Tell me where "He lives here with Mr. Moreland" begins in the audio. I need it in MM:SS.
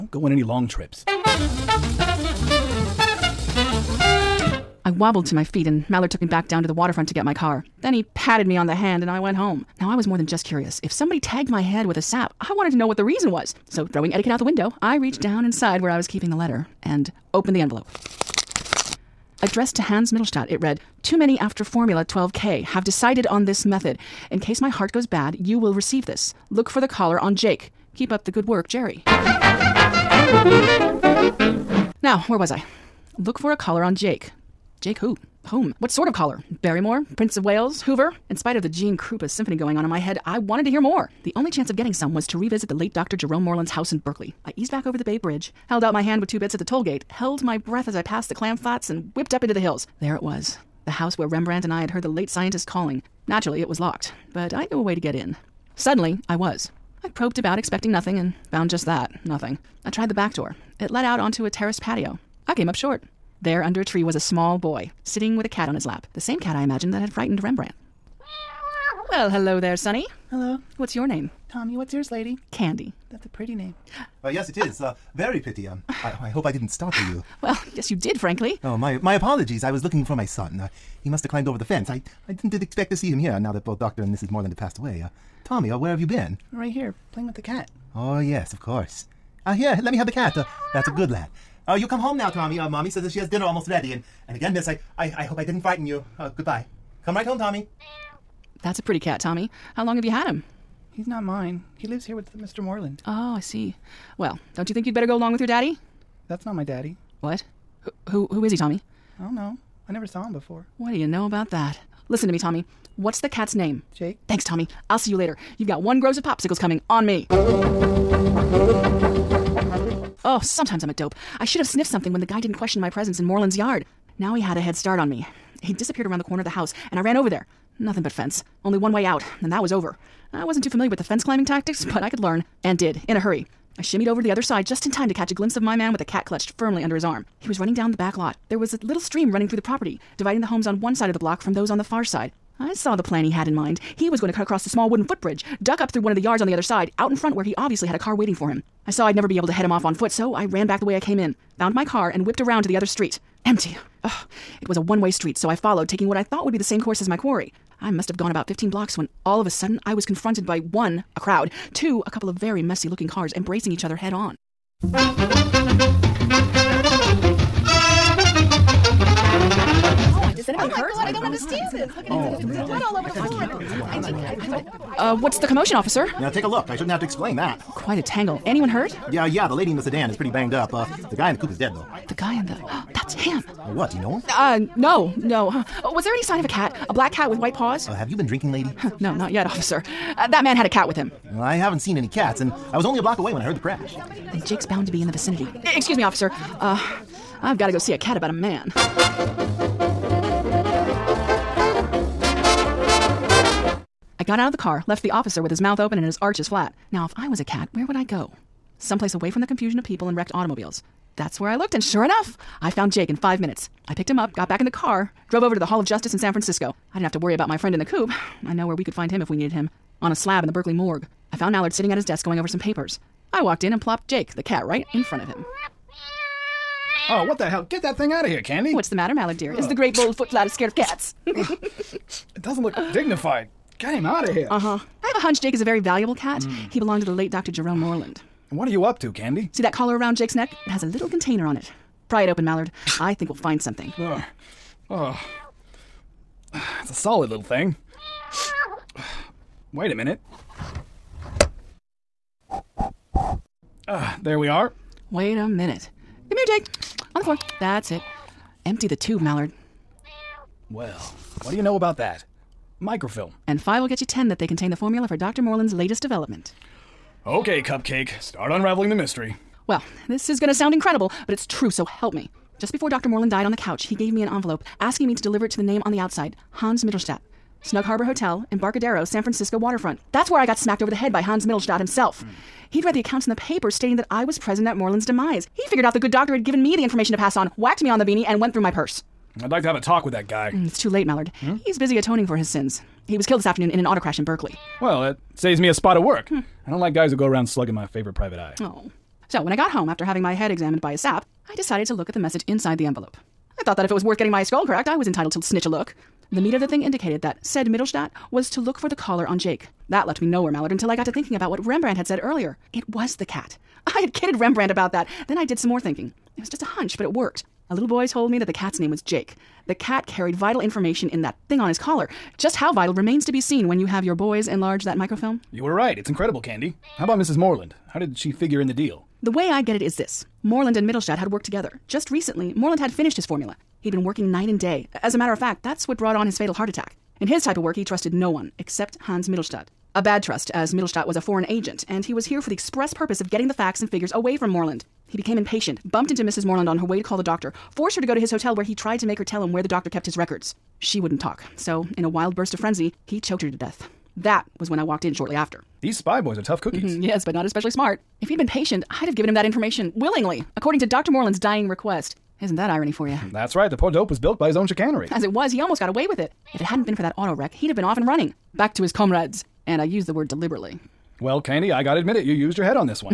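01:41.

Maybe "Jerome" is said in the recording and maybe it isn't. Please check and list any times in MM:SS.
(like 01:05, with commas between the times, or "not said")
00:43, 03:57.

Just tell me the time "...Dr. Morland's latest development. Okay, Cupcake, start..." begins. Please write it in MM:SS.
04:25.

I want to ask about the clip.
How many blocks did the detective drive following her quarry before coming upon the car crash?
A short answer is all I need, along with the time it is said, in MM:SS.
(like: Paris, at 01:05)
15, at 02:38.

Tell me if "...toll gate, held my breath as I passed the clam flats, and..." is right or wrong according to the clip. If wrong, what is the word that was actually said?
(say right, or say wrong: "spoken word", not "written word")
right.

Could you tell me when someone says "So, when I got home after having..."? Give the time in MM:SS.
04:59.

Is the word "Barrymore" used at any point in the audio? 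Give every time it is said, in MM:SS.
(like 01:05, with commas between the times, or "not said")
00:36.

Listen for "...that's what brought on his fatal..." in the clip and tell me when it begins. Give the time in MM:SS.
05:35.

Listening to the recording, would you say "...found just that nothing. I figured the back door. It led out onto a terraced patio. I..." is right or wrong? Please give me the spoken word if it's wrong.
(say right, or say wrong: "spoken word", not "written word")
wrong: "tried", not "figured".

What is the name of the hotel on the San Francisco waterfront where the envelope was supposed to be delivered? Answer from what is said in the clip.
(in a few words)
Snug Harbor Hotel.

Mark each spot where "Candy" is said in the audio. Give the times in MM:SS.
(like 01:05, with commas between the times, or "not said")
01:12, 03:48, 03:59, 05:26, 06:11.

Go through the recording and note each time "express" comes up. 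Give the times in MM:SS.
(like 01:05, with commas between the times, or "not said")
05:42.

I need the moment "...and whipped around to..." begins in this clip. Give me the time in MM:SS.
02:32.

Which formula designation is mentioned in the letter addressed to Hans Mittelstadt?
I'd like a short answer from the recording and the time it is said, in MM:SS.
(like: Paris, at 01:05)
Formula 12K, at 00:21.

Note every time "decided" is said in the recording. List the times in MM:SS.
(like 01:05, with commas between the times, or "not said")
00:22, 05:01.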